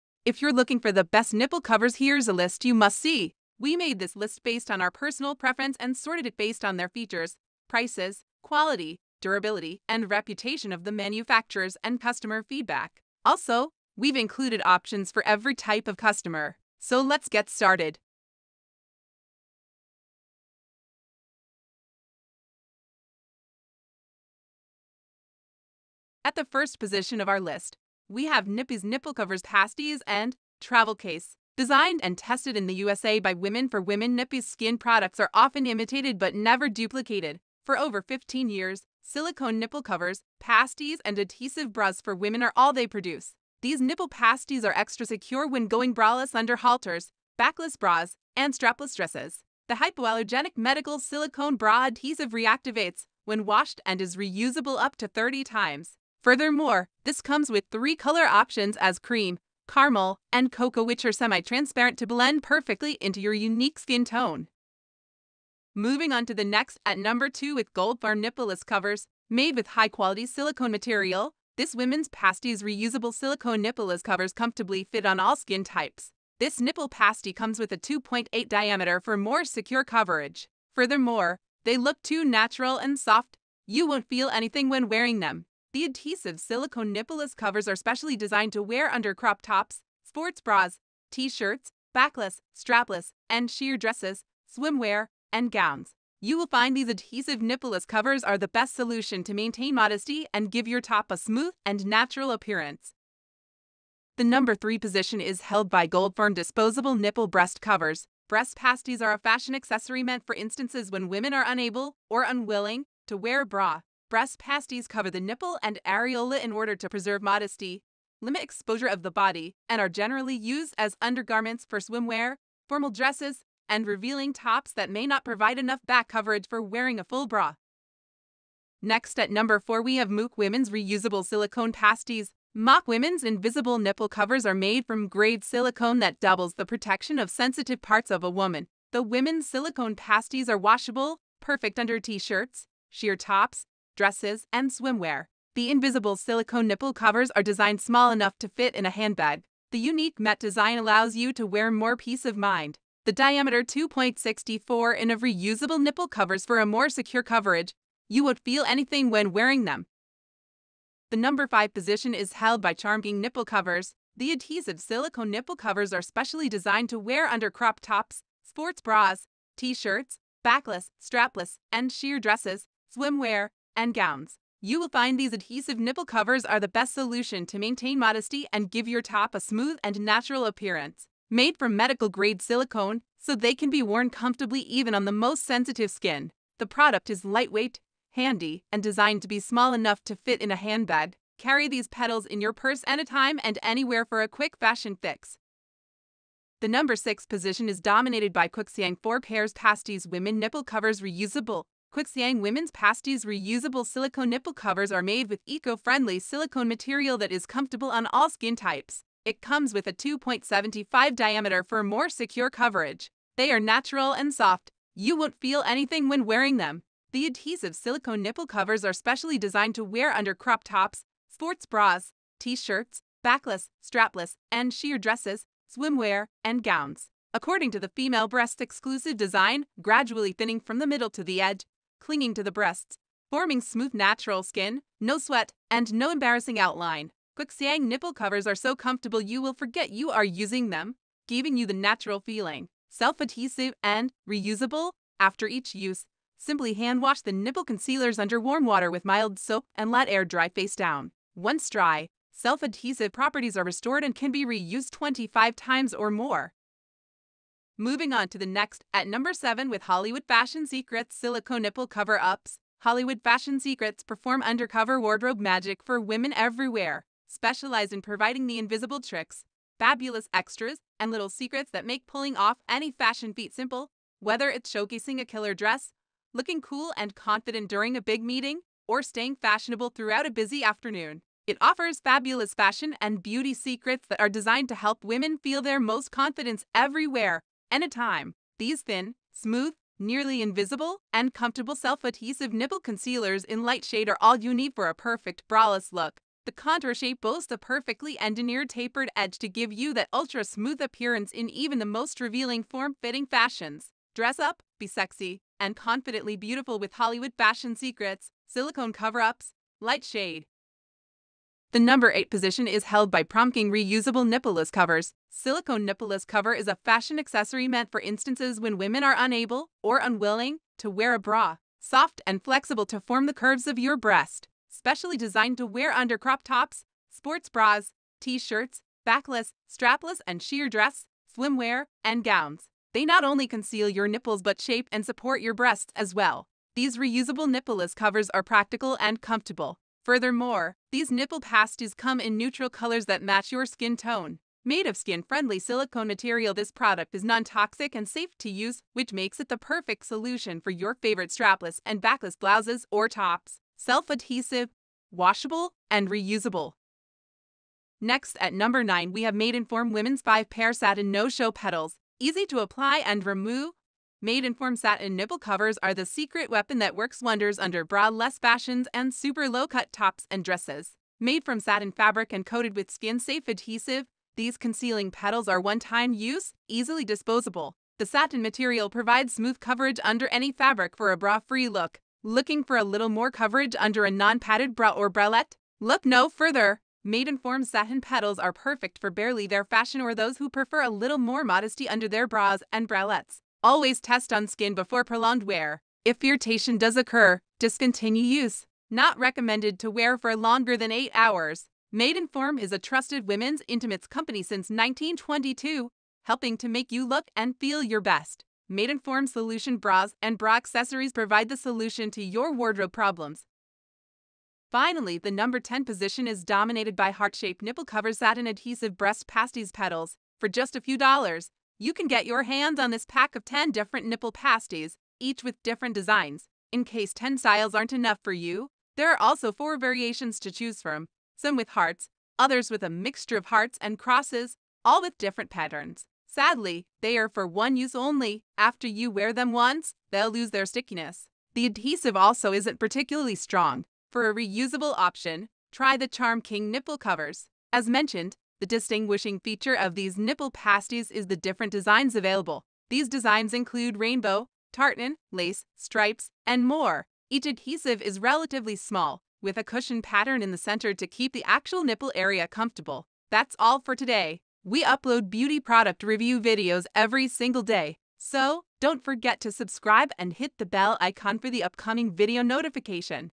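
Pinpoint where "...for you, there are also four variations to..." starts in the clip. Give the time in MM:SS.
07:08.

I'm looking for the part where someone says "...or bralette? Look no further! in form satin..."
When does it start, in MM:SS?
06:24.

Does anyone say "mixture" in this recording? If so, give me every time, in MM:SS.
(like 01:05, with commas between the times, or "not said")
07:12.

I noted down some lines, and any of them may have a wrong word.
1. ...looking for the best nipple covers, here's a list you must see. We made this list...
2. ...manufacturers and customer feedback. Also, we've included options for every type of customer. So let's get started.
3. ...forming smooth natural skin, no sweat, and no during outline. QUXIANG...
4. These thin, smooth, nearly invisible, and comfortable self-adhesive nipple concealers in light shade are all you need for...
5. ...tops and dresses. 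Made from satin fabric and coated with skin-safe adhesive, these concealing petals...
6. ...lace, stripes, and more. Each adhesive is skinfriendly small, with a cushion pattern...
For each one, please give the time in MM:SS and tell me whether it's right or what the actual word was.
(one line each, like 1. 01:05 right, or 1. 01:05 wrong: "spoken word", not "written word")
1. 00:00 right
2. 00:10 right
3. 03:53 wrong: "embarrassing", not "during"
4. 04:48 right
5. 06:09 right
6. 07:35 wrong: "relatively", not "skinfriendly".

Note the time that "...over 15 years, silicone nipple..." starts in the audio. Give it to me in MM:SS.
00:37.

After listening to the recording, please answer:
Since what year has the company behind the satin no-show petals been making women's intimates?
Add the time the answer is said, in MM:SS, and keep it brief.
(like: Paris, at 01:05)
1922, at 06:44.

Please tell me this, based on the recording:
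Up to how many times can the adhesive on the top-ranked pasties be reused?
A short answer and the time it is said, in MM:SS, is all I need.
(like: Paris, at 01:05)
30, at 00:54.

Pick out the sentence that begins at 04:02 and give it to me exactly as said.
Self-adhesive and reusable after each use.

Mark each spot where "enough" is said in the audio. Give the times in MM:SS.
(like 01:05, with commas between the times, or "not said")
02:05, 02:28, 03:09, 07:07.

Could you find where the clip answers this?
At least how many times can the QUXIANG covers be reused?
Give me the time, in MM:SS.
04:14.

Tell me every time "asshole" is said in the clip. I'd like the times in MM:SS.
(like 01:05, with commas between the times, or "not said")
not said.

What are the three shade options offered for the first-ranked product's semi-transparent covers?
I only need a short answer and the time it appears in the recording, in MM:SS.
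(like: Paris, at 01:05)
cream, caramel, and cocoa, at 00:58.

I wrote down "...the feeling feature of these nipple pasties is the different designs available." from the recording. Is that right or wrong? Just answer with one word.
wrong.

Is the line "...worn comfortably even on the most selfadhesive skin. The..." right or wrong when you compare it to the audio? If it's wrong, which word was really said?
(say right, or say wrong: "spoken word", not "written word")
wrong: "sensitive", not "selfadhesive".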